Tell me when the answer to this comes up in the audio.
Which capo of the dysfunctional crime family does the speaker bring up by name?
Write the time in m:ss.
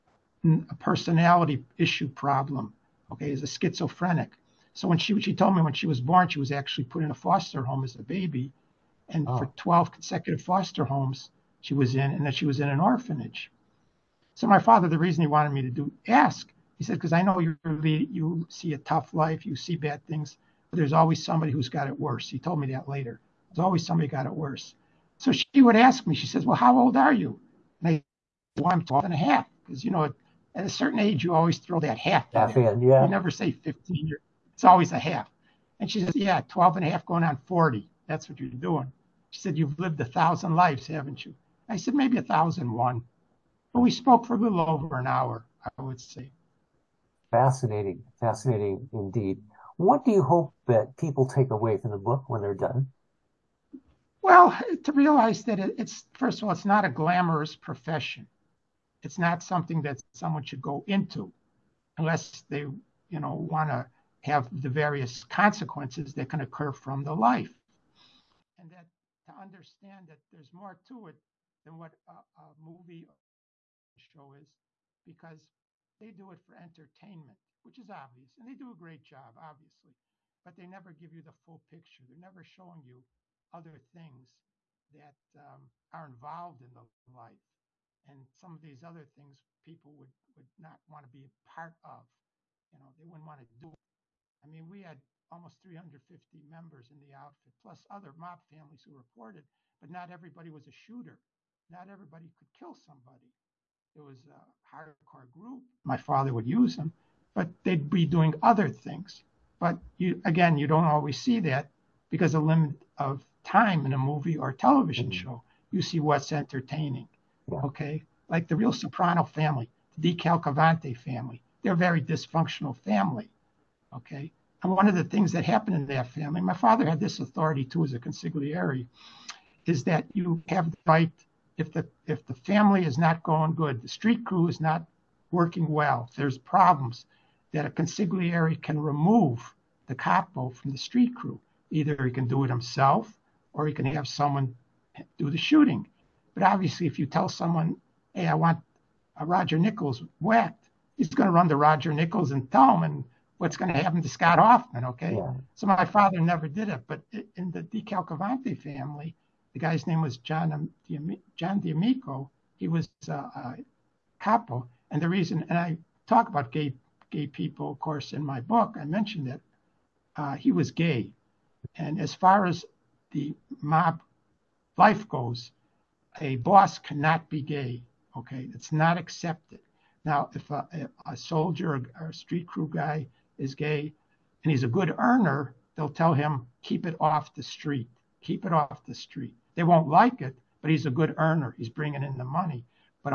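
2:41.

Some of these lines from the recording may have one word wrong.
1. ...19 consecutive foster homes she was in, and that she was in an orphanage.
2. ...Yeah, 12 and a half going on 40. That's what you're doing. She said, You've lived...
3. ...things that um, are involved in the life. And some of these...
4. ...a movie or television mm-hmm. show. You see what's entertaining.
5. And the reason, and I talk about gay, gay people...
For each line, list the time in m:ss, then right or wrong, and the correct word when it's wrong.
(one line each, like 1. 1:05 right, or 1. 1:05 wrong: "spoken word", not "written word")
1. 0:09 wrong: "12", not "19"
2. 0:36 right
3. 1:23 right
4. 1:53 right
5. 2:44 right.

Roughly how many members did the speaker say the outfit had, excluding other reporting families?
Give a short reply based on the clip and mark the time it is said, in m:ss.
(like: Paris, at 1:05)
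350, at 1:35.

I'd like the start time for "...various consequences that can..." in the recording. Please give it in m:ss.
1:04.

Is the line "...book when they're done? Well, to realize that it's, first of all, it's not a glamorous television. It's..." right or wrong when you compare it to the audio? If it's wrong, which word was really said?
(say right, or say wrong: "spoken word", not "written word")
wrong: "profession", not "television".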